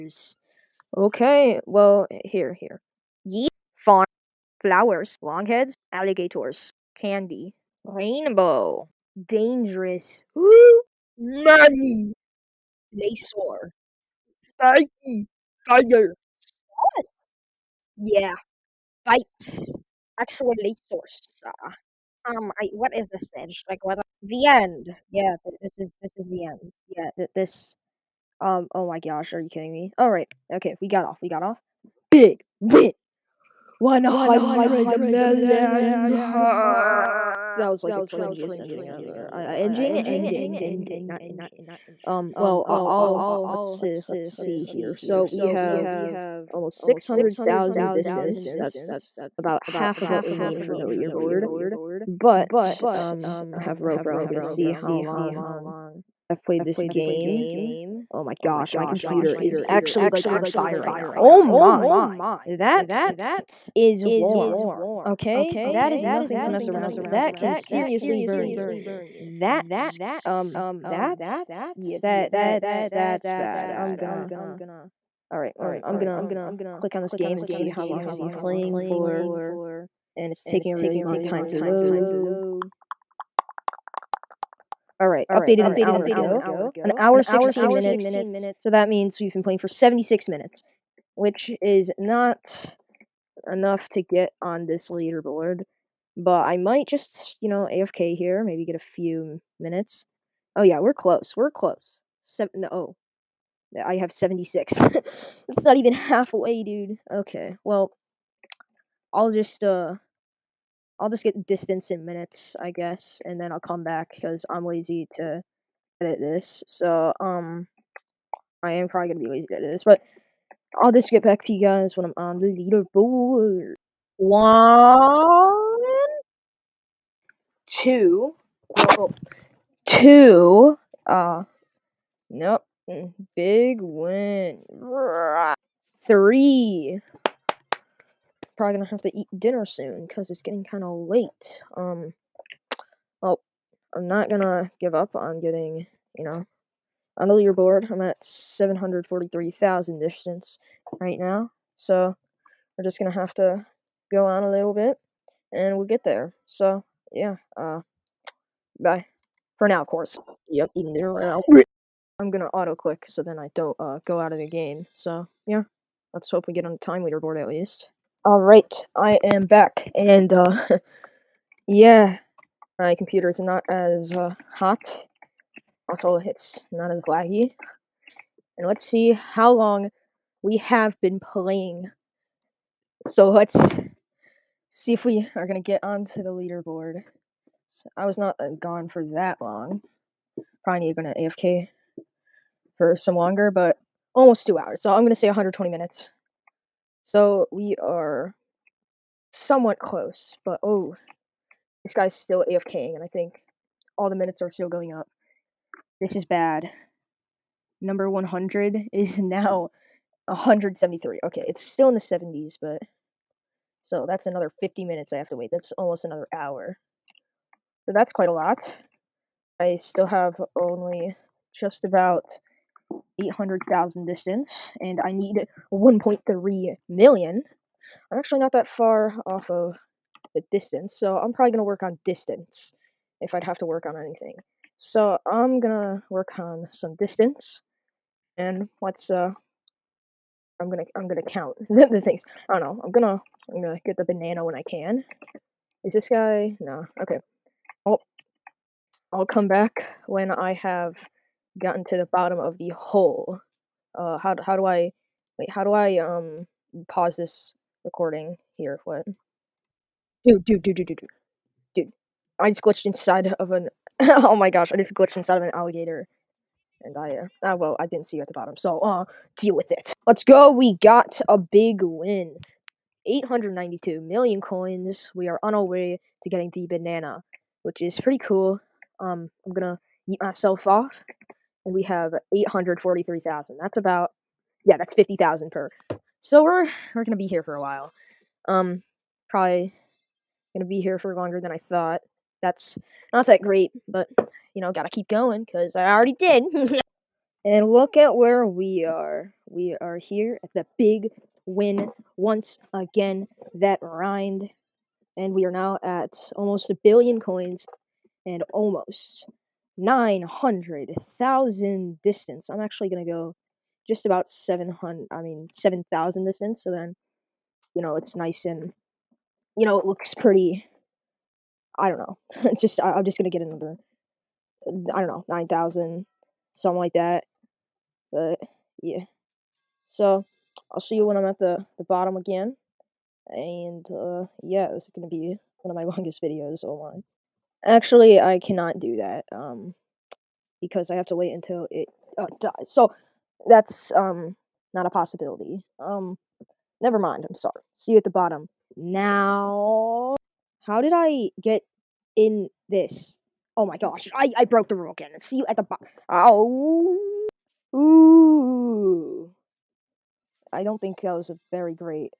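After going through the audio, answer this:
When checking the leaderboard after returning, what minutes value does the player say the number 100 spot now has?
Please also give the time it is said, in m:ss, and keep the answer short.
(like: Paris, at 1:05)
173, at 3:30.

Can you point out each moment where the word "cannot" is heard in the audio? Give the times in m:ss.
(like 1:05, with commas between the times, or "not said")
5:38.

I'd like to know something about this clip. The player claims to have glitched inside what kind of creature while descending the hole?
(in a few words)
An alligator.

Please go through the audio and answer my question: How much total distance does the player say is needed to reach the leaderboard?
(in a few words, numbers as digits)
1.3 million.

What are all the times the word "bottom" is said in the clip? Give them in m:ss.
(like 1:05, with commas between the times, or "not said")
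4:12, 4:28, 5:31, 5:48, 5:55.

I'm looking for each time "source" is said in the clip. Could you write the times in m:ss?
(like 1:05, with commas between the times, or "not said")
0:20.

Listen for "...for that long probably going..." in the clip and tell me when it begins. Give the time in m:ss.
3:08.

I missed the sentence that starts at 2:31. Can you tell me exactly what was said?
So we're just going to have to go on a little bit and we'll get there.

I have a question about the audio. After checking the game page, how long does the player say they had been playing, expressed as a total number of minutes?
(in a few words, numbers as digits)
76 minutes.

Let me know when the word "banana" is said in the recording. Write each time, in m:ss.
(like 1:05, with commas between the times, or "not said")
4:04, 4:36.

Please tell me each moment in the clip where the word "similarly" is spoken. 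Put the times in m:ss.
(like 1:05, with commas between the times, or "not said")
not said.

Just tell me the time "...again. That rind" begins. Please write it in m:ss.
5:02.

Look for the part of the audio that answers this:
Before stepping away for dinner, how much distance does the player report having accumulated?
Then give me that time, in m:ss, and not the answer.
2:28.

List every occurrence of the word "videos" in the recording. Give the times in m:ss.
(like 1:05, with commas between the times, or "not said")
5:36.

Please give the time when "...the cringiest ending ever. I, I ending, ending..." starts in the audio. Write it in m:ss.
0:37.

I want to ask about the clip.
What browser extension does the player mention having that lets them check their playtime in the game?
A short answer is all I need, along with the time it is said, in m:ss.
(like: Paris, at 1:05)
Ropro, at 0:53.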